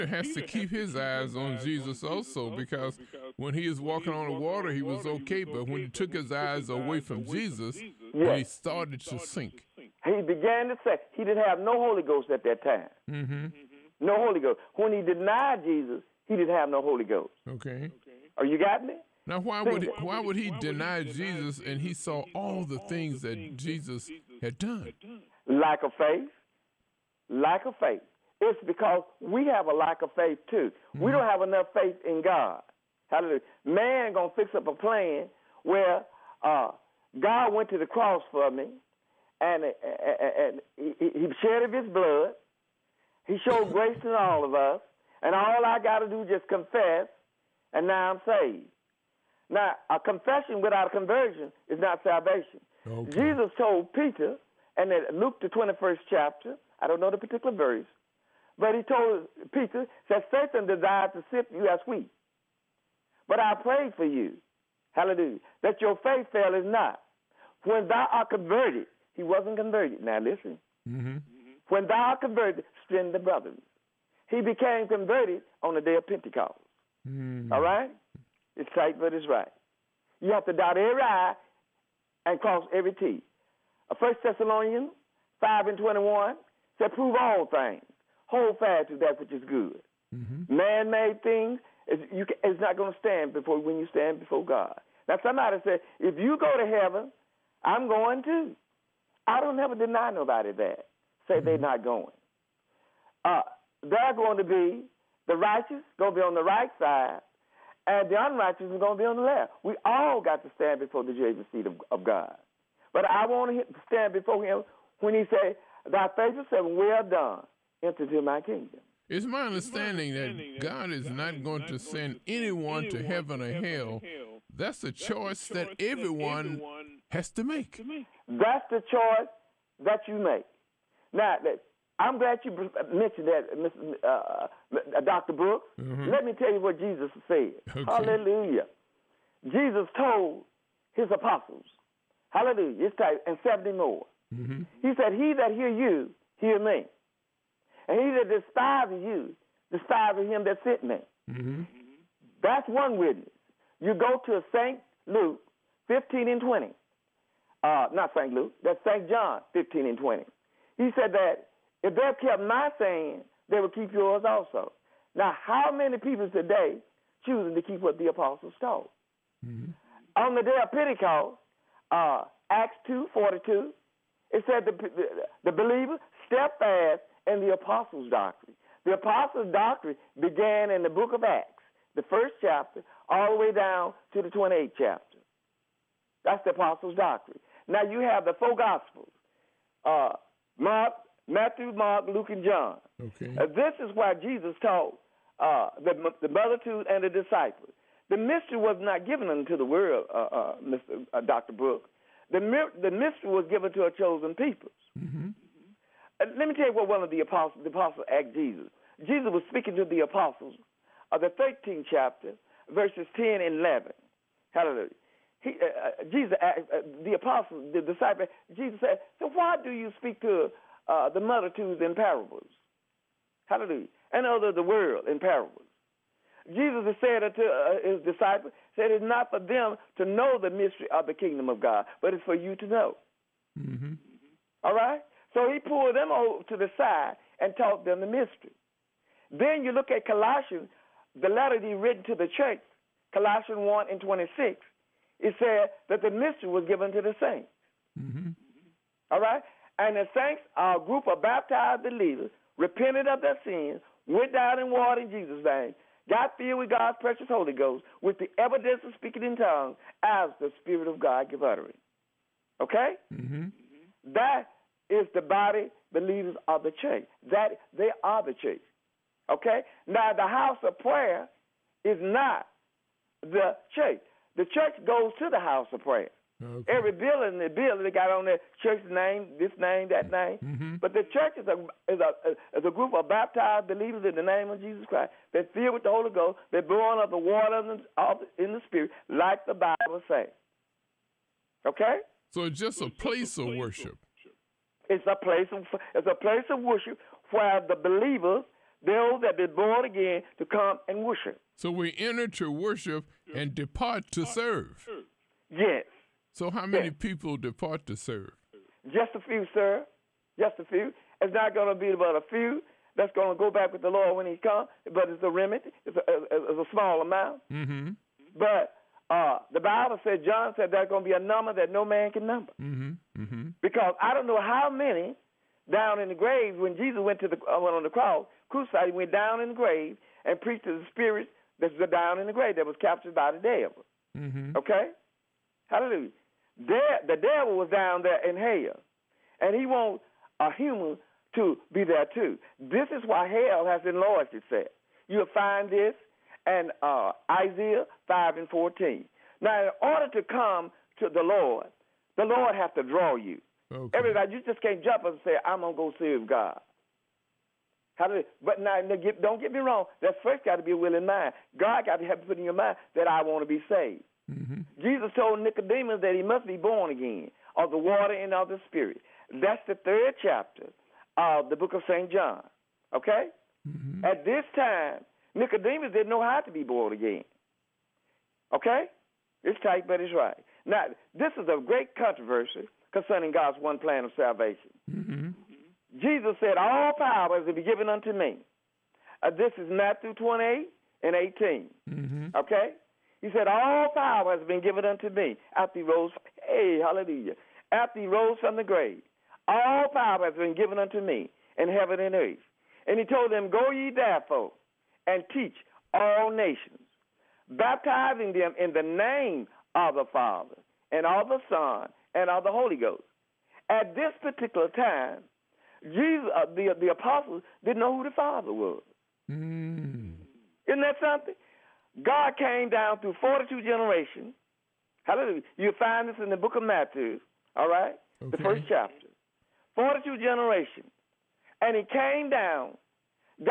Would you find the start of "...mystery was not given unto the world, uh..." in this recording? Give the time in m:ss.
3:18.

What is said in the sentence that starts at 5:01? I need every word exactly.
So we enter to worship and depart to serve.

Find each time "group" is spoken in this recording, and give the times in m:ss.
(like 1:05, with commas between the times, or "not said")
4:10, 4:42.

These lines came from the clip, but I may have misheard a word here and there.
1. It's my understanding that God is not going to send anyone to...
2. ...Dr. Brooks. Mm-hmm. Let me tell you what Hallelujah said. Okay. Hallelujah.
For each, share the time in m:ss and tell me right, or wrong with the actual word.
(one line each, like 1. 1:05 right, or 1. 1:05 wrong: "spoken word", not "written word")
1. 1:59 right
2. 2:15 wrong: "Jesus", not "Hallelujah".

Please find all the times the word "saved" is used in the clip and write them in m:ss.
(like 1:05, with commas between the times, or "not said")
0:48, 6:03.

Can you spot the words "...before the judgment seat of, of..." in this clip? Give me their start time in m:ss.
1:50.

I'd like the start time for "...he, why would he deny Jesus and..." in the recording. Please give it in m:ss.
0:19.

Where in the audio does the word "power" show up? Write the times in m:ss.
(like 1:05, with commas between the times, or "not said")
6:26, 6:33, 6:39.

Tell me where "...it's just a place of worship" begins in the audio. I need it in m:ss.
4:52.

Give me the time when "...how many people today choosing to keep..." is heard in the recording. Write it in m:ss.
2:45.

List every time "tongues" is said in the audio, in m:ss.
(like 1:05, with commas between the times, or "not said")
4:19.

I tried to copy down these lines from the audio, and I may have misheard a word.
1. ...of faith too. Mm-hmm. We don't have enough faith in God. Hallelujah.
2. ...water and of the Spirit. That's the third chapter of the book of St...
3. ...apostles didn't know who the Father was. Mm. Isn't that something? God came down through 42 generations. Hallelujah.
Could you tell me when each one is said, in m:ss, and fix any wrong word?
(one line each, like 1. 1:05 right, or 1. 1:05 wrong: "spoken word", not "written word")
1. 0:30 right
2. 6:07 right
3. 6:56 right.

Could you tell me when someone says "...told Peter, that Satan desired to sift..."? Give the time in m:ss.
0:58.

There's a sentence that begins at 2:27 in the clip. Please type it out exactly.
And he that despises you, despises him that sent me.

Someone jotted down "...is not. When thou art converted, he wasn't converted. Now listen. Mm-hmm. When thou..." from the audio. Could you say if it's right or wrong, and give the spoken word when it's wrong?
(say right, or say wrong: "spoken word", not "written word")
right.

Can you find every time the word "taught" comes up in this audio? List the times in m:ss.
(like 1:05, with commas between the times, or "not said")
2:48, 3:14, 3:57.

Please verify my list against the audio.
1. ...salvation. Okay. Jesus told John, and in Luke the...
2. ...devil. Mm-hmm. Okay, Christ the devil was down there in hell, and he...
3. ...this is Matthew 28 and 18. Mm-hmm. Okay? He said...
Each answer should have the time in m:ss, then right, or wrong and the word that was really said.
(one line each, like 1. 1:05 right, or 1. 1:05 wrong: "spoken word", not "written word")
1. 0:52 wrong: "Peter", not "John"
2. 5:33 wrong: "Hallelujah", not "Christ"
3. 6:29 right.